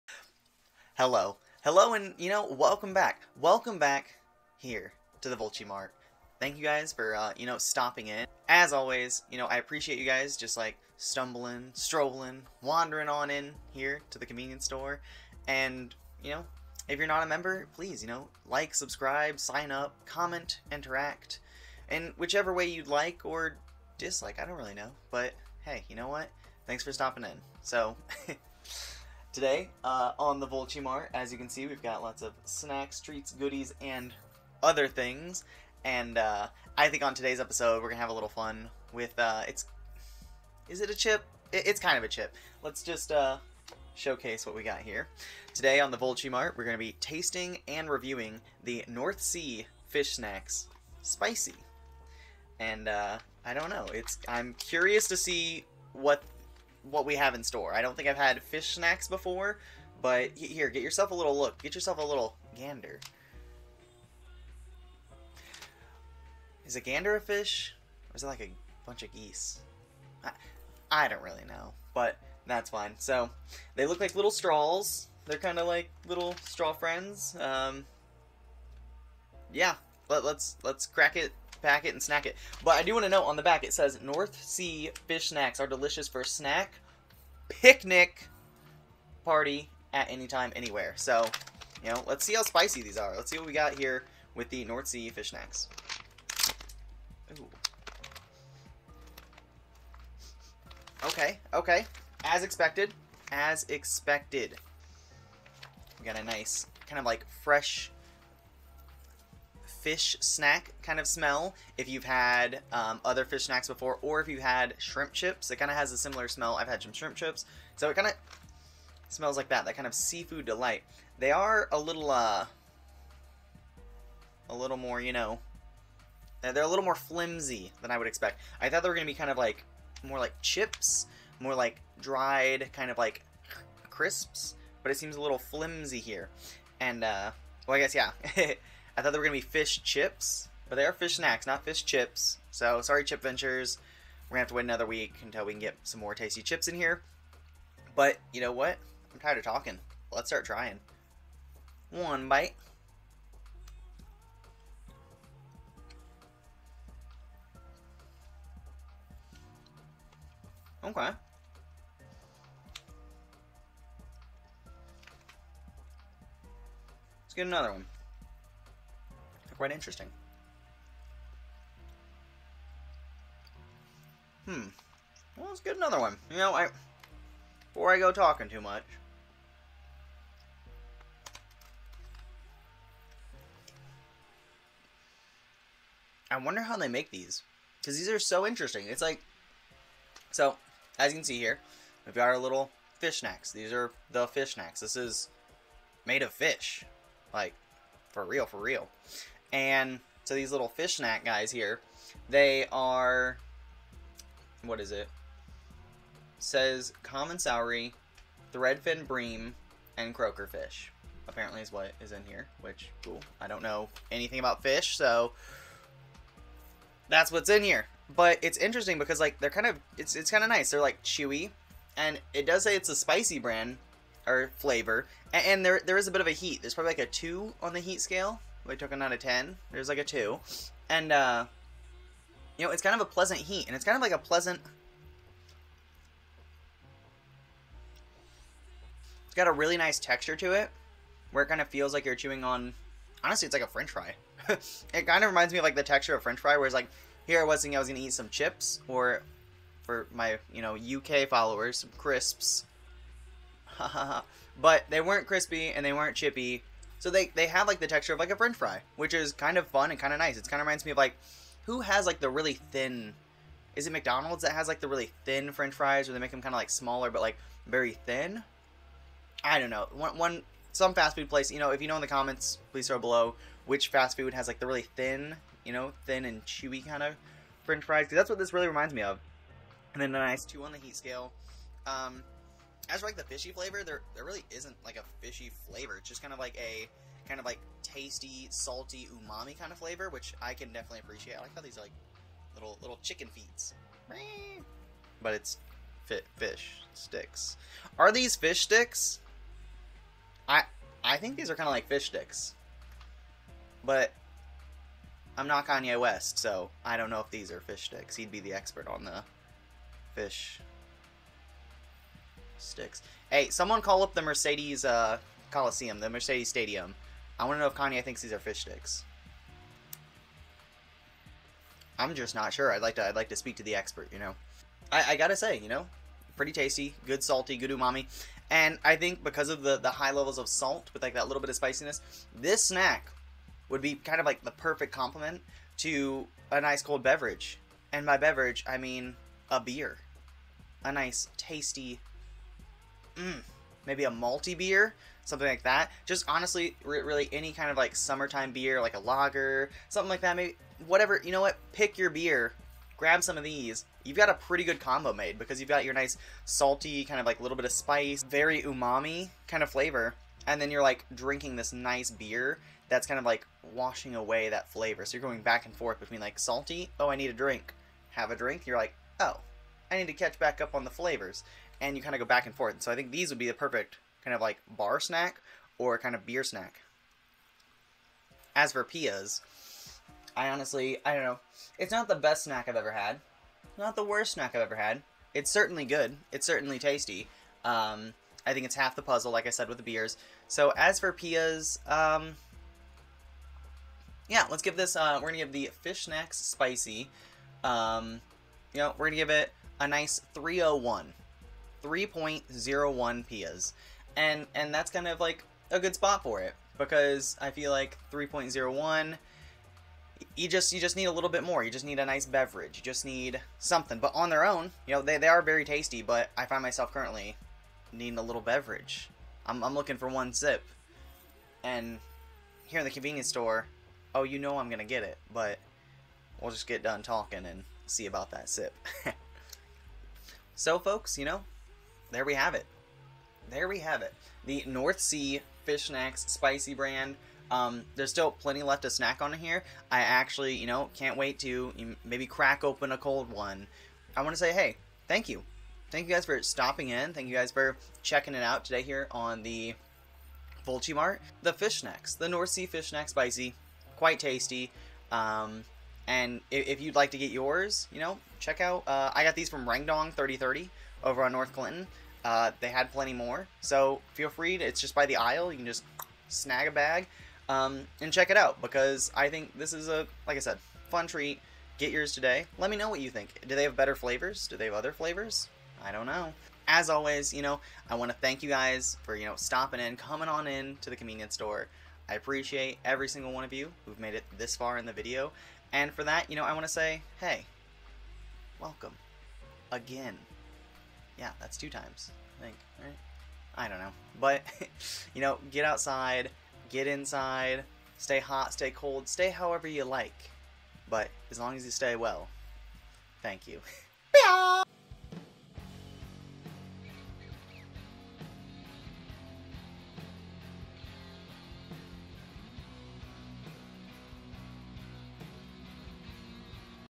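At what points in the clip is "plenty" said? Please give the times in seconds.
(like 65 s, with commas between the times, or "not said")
438 s, 462 s.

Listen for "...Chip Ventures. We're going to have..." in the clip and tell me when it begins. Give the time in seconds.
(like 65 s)
143 s.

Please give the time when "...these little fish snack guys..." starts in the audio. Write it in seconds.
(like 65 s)
200 s.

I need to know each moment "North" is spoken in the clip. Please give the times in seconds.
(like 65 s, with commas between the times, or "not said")
48 s, 84 s, 94 s, 434 s, 452 s, 461 s.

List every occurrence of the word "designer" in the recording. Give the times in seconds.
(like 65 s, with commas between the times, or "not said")
not said.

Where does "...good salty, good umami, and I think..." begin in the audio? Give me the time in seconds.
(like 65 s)
327 s.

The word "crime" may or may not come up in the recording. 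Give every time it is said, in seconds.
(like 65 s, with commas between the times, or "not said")
not said.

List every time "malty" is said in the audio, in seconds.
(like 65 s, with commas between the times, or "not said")
344 s.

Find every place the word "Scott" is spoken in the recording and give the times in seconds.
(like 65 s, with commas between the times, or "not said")
not said.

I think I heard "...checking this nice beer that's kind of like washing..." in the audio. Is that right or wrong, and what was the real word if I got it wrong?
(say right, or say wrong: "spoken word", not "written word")
wrong: "drinking", not "checking".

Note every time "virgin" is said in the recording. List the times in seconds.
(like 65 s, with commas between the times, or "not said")
not said.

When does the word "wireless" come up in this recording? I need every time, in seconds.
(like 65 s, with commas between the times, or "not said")
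not said.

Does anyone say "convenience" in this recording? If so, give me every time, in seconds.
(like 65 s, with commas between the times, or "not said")
14 s, 422 s, 480 s.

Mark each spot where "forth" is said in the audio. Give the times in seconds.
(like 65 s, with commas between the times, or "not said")
365 s, 372 s.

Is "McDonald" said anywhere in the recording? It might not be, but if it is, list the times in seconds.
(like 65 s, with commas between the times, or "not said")
263 s.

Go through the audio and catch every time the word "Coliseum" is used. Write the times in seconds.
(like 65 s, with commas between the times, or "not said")
315 s.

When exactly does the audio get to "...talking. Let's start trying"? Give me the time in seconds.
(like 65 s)
149 s.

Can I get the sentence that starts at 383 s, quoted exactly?
Not the worst snack I've ever had.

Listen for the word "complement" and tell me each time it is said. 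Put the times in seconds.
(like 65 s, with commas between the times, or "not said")
334 s.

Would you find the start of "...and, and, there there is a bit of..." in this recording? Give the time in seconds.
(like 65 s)
225 s.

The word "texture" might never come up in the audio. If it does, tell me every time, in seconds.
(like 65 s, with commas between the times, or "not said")
239 s, 245 s, 257 s.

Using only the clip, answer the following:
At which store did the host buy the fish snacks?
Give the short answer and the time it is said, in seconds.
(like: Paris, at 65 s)
Rangdong 3030, at 459 s.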